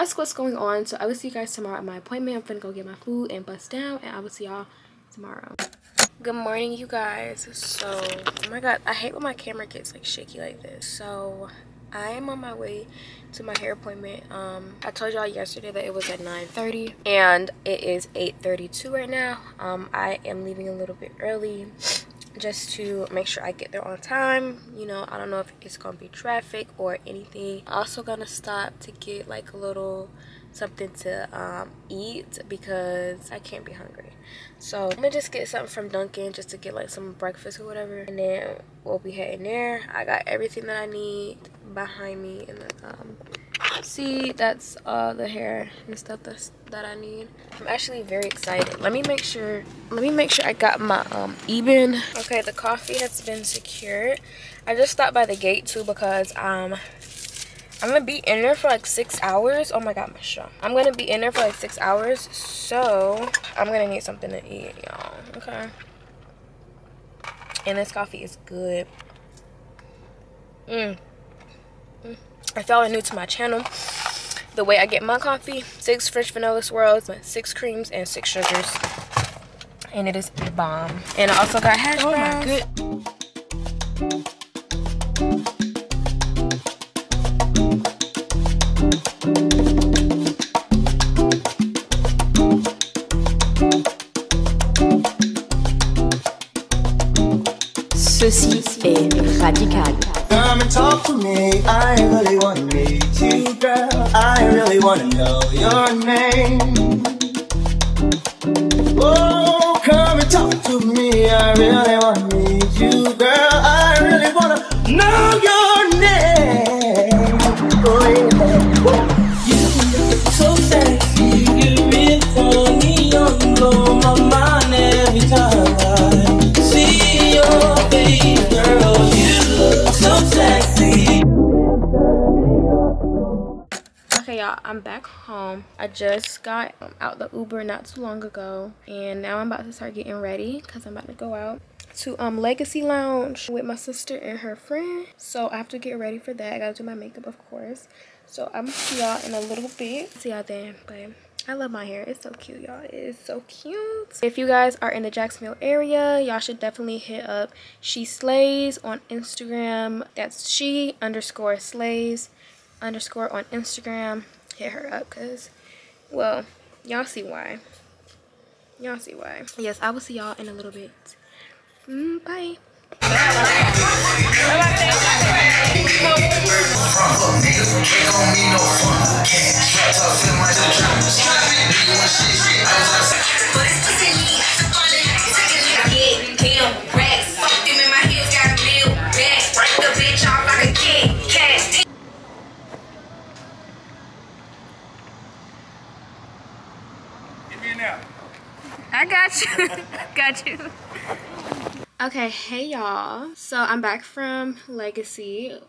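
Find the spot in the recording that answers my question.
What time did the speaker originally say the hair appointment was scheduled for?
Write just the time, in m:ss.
0:16.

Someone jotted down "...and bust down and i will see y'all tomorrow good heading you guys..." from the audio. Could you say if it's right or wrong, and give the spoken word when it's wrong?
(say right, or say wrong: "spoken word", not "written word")
wrong: "morning", not "heading".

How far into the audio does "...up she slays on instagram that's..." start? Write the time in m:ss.
2:37.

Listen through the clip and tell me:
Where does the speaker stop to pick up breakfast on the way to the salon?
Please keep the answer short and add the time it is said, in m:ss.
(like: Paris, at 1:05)
Dunkin', at 0:35.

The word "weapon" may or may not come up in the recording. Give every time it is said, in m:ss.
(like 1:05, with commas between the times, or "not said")
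not said.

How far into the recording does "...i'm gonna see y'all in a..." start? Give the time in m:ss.
2:28.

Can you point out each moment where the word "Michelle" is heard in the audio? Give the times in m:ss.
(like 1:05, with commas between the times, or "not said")
1:00.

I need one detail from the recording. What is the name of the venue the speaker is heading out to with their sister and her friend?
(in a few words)
Legacy Lounge.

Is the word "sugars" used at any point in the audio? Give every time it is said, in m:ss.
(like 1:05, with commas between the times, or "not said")
1:18.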